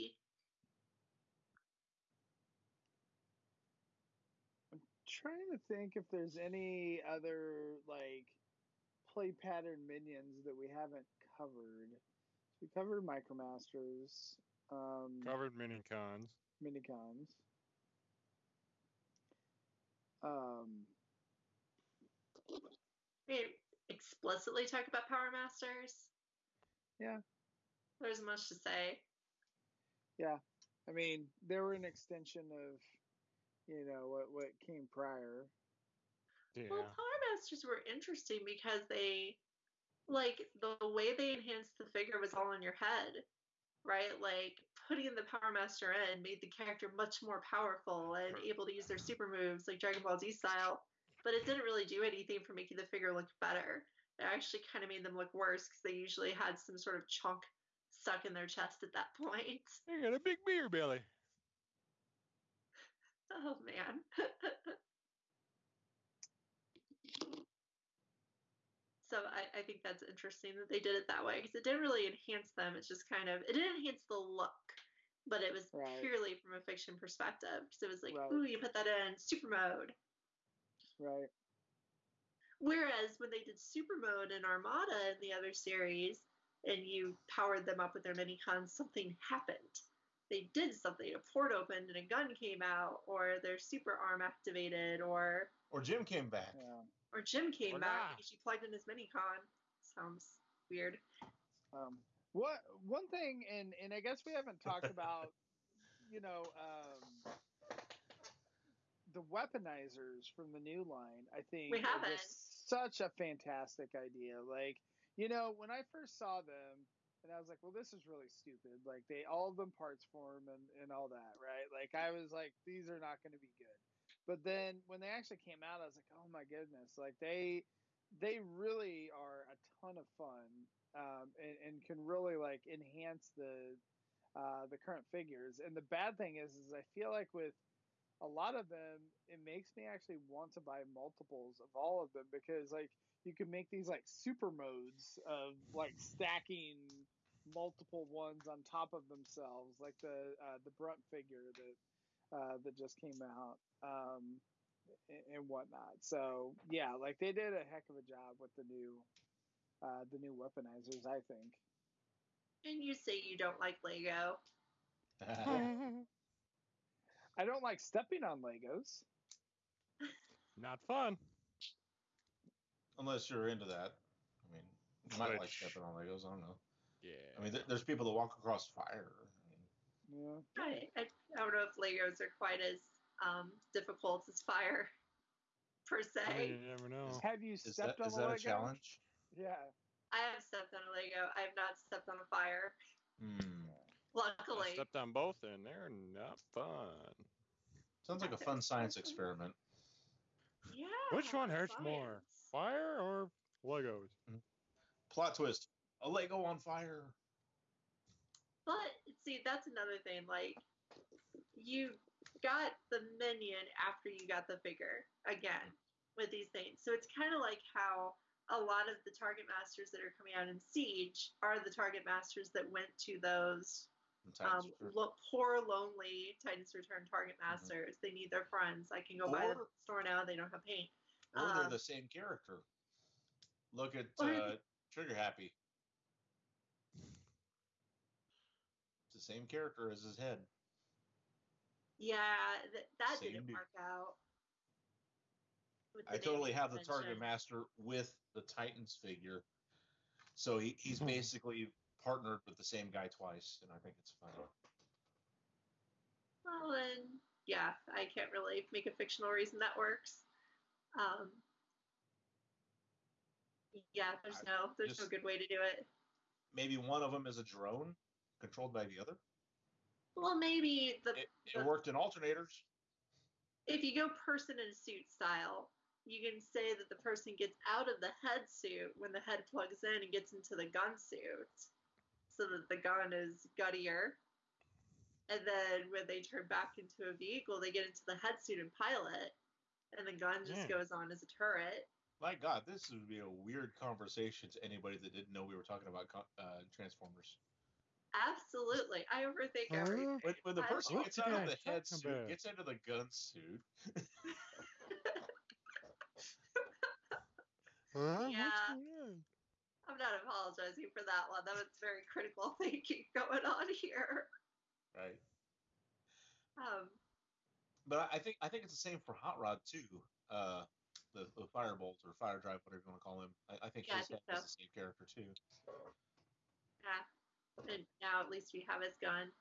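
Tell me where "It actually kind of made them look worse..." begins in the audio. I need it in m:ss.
0:54.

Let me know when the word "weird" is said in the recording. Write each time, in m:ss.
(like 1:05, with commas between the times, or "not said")
1:40, 4:53.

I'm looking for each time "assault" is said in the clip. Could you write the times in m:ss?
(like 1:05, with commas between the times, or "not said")
not said.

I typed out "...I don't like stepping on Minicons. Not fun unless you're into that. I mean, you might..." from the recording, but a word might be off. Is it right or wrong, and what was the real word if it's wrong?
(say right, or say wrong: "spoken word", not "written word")
wrong: "Legos", not "Minicons".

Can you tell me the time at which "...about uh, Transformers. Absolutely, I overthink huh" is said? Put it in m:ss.
4:55.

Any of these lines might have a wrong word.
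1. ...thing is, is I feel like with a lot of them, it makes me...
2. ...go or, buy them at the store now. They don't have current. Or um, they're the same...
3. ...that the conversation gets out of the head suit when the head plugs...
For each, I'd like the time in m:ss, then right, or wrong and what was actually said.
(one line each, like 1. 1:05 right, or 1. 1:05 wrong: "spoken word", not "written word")
1. 2:16 right
2. 3:49 wrong: "paint", not "current"
3. 4:36 wrong: "person", not "conversation".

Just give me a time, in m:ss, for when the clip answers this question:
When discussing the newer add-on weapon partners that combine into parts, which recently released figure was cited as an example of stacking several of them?
2:30.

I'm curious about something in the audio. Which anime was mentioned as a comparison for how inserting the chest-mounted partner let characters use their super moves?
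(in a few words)
Dragon Ball Z.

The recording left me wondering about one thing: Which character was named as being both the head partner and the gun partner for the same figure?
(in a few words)
Trigger Happy.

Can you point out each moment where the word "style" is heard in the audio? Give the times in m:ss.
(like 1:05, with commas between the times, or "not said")
0:50, 4:35.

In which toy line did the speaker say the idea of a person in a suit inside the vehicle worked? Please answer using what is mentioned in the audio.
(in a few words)
Alternators.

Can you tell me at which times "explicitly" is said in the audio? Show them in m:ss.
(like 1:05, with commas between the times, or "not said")
0:23.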